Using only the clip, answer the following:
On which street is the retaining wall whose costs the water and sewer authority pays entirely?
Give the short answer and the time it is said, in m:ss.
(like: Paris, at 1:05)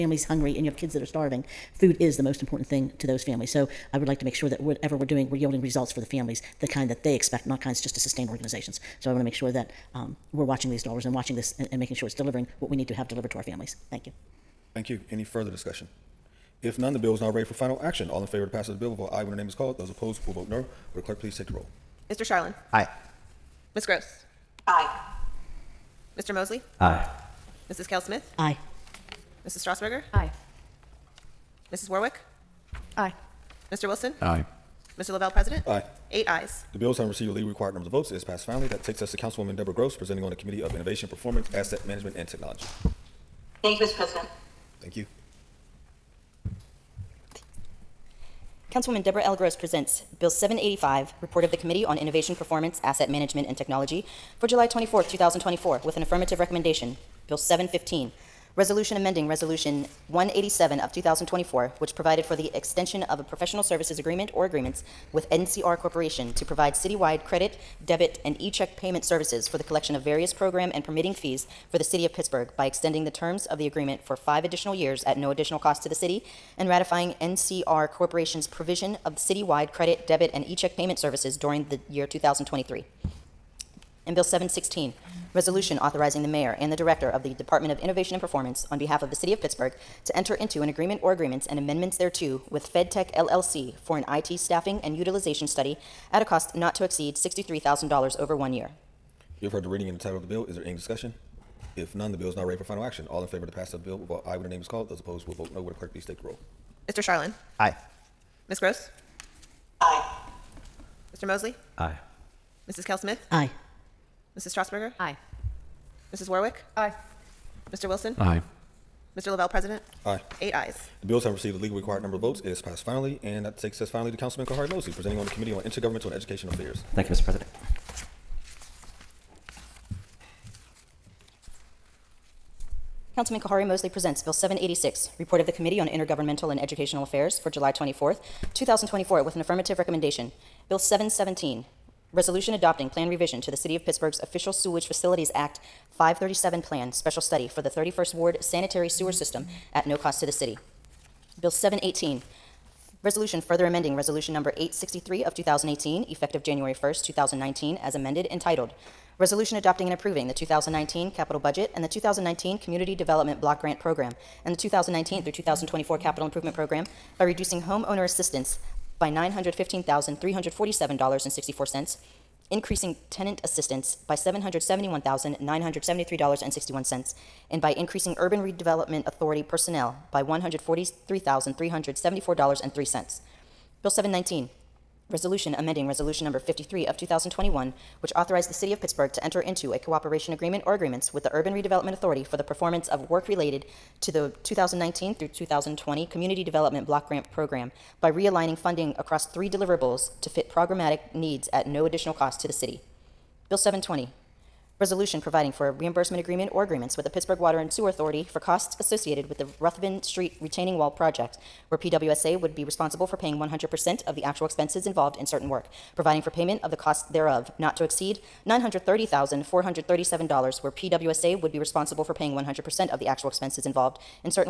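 Ruthven Street, at 3:29.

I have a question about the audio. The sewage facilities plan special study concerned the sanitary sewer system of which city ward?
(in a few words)
31st Ward.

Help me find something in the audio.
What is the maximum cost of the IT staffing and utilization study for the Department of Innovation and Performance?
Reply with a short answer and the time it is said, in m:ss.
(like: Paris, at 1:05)
$63,000, at 1:37.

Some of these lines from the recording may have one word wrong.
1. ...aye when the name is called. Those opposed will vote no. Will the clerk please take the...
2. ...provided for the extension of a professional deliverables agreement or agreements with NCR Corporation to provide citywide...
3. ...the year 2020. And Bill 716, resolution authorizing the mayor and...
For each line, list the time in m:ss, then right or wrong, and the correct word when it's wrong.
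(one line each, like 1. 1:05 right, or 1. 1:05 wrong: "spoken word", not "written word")
1. 0:19 right
2. 1:01 wrong: "services", not "deliverables"
3. 1:21 wrong: "2023", not "2020".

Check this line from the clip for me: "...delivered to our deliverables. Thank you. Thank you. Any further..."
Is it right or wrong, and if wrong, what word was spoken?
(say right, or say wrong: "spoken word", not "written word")
wrong: "families", not "deliverables".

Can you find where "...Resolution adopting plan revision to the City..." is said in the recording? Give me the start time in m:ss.
2:22.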